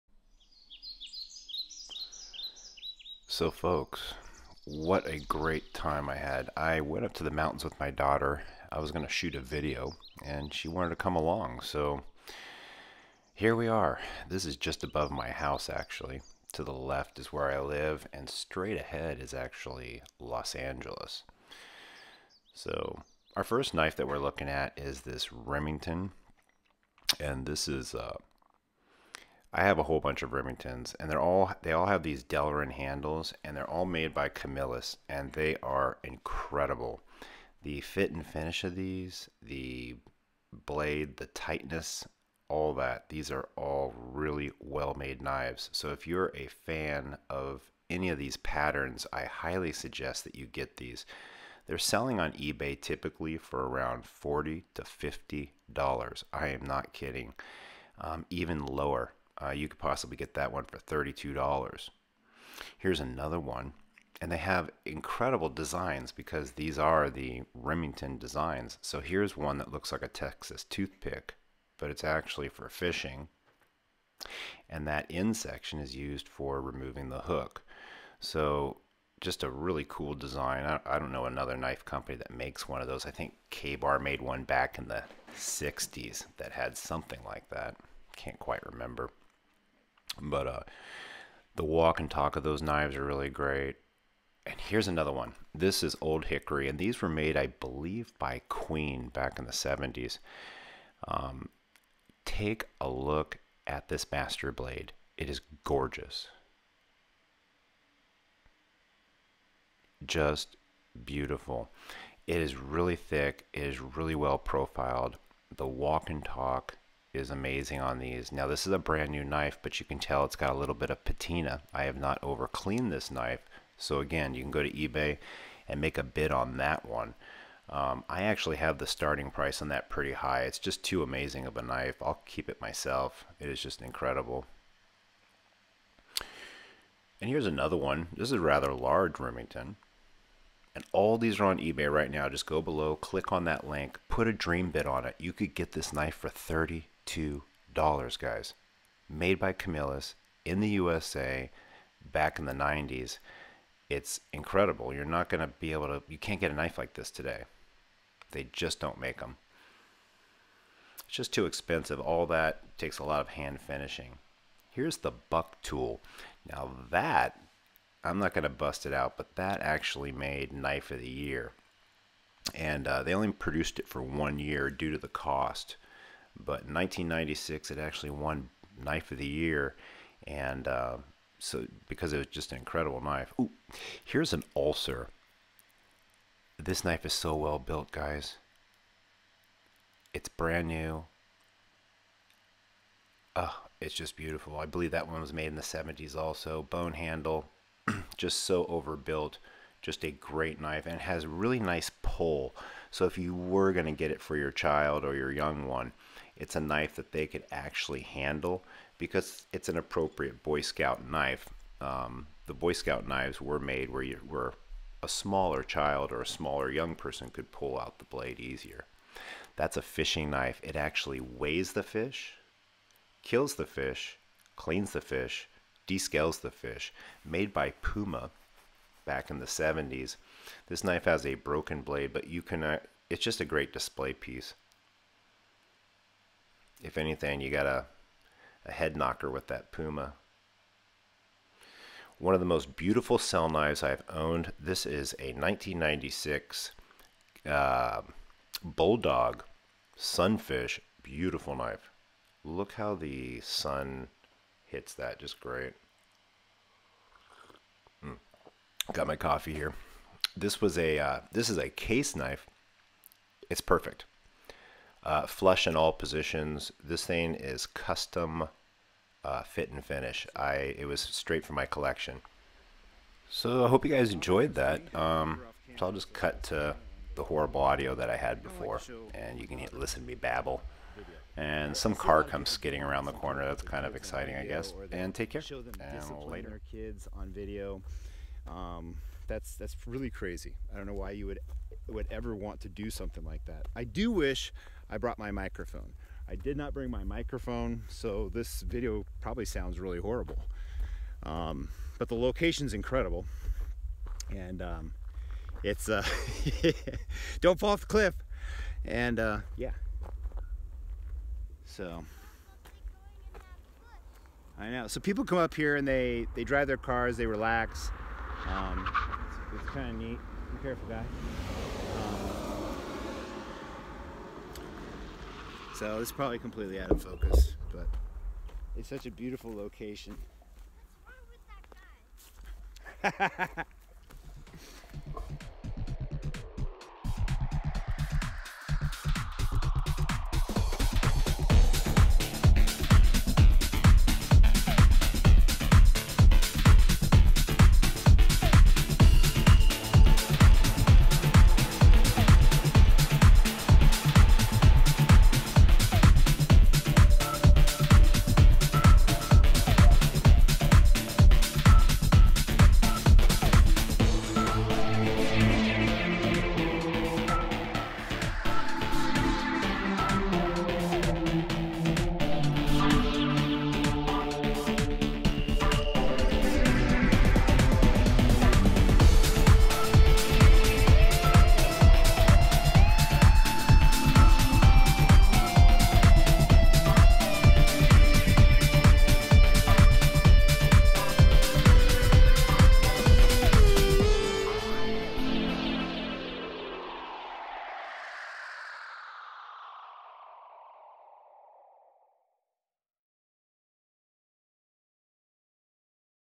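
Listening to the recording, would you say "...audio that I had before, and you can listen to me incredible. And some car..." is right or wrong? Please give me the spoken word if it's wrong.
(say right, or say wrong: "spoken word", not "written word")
wrong: "babble", not "incredible".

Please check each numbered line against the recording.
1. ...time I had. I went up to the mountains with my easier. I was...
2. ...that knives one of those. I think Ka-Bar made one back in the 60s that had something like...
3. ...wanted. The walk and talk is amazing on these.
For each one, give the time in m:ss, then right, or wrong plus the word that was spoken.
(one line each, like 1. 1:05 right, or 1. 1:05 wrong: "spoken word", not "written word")
1. 0:05 wrong: "daughter", not "easier"
2. 1:22 wrong: "makes", not "knives"
3. 1:54 wrong: "profiled", not "wanted".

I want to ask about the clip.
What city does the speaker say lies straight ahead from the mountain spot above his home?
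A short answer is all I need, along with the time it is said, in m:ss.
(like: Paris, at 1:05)
Los Angeles, at 0:20.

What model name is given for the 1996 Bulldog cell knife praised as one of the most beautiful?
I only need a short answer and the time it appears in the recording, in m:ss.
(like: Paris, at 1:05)
Sunfish, at 4:09.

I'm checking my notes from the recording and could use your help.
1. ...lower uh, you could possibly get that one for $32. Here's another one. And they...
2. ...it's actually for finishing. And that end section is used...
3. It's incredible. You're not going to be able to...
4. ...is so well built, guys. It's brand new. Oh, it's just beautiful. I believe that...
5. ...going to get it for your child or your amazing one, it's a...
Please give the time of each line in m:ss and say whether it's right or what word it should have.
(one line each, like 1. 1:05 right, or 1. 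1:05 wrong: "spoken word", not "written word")
1. 0:58 right
2. 1:11 wrong: "fishing", not "finishing"
3. 2:33 right
4. 3:07 right
5. 3:23 wrong: "young", not "amazing".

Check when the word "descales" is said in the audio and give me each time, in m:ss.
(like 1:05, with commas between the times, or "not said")
3:45.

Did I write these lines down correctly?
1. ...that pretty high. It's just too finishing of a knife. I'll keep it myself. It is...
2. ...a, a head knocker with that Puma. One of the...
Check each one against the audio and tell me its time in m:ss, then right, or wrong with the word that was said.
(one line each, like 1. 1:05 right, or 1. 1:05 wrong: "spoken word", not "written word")
1. 2:09 wrong: "amazing", not "finishing"
2. 3:57 right.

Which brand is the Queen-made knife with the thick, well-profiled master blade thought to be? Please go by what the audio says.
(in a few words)
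Old Hickory.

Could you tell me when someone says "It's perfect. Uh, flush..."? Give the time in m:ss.
4:23.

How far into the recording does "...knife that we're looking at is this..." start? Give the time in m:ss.
0:23.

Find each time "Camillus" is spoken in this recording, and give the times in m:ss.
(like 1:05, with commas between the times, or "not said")
0:34, 2:29.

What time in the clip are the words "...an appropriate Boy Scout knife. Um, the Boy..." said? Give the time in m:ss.
3:29.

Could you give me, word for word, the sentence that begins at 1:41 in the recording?
Um, take a look at this master blade.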